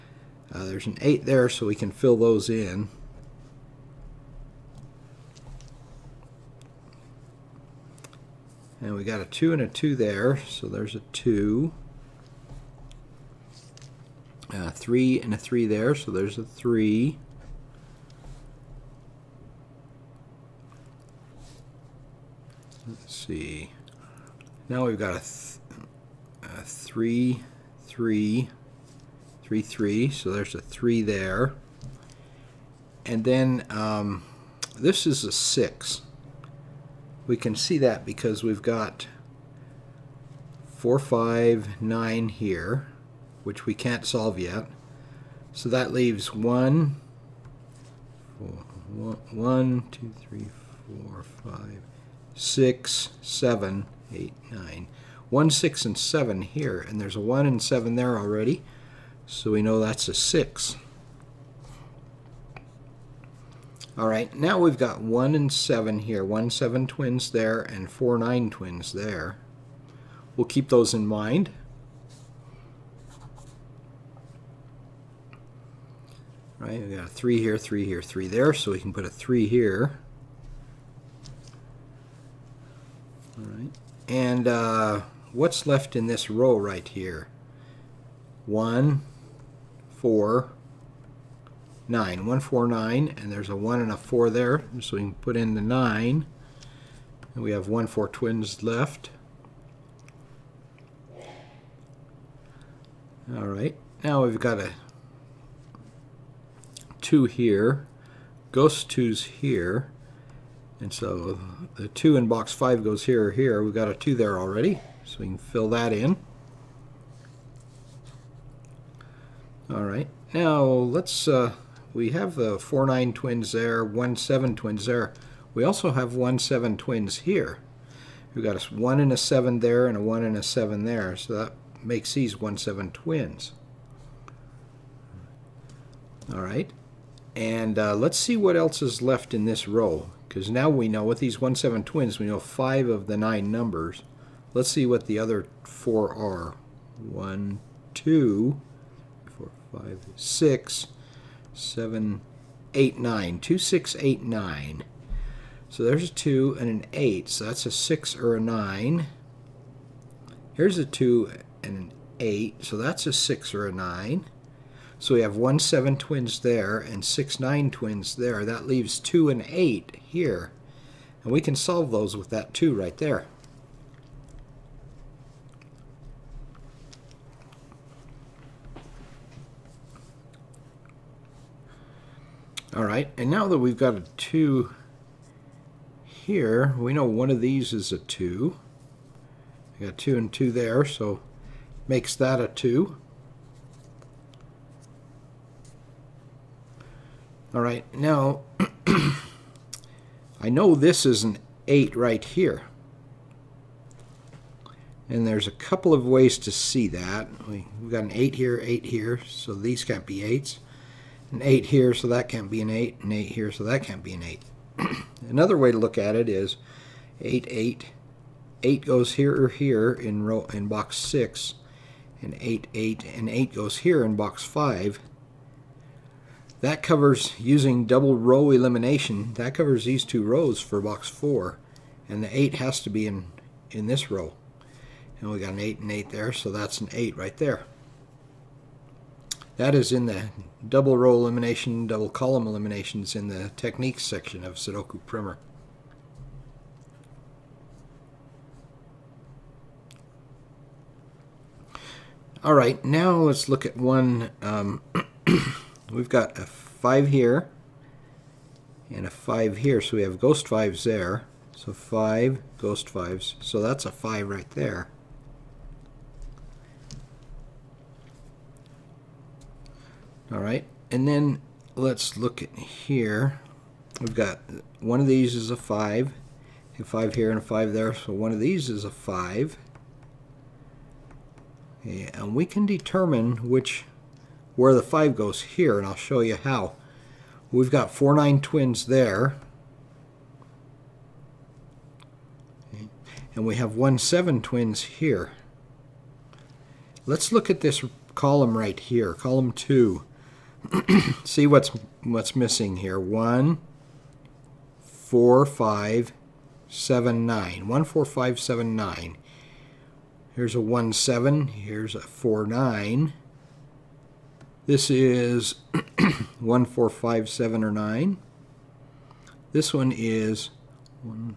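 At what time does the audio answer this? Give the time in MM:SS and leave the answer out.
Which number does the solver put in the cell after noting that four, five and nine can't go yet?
00:59.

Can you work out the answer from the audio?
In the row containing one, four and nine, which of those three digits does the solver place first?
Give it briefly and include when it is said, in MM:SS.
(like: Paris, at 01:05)
9, at 01:34.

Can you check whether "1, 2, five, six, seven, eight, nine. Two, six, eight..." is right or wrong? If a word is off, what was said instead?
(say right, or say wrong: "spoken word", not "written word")
right.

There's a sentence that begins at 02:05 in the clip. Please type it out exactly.
We also have 1-7 twins here.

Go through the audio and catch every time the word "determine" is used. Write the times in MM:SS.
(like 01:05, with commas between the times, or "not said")
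04:42.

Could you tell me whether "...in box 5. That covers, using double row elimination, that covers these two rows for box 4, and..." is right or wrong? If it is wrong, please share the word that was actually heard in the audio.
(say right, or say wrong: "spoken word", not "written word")
right.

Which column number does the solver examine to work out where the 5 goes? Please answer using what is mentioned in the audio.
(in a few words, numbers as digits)
2.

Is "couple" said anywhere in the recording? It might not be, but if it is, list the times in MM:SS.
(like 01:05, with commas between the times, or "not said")
03:25.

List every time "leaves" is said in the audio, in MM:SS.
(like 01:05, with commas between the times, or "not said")
00:45, 02:48.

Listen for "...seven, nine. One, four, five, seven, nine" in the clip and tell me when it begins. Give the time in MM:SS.
05:06.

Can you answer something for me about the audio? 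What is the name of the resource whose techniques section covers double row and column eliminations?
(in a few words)
Sudoku Primer.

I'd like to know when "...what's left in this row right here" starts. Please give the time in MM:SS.
01:25.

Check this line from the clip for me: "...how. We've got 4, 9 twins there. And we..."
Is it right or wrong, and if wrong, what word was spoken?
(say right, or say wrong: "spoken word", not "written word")
right.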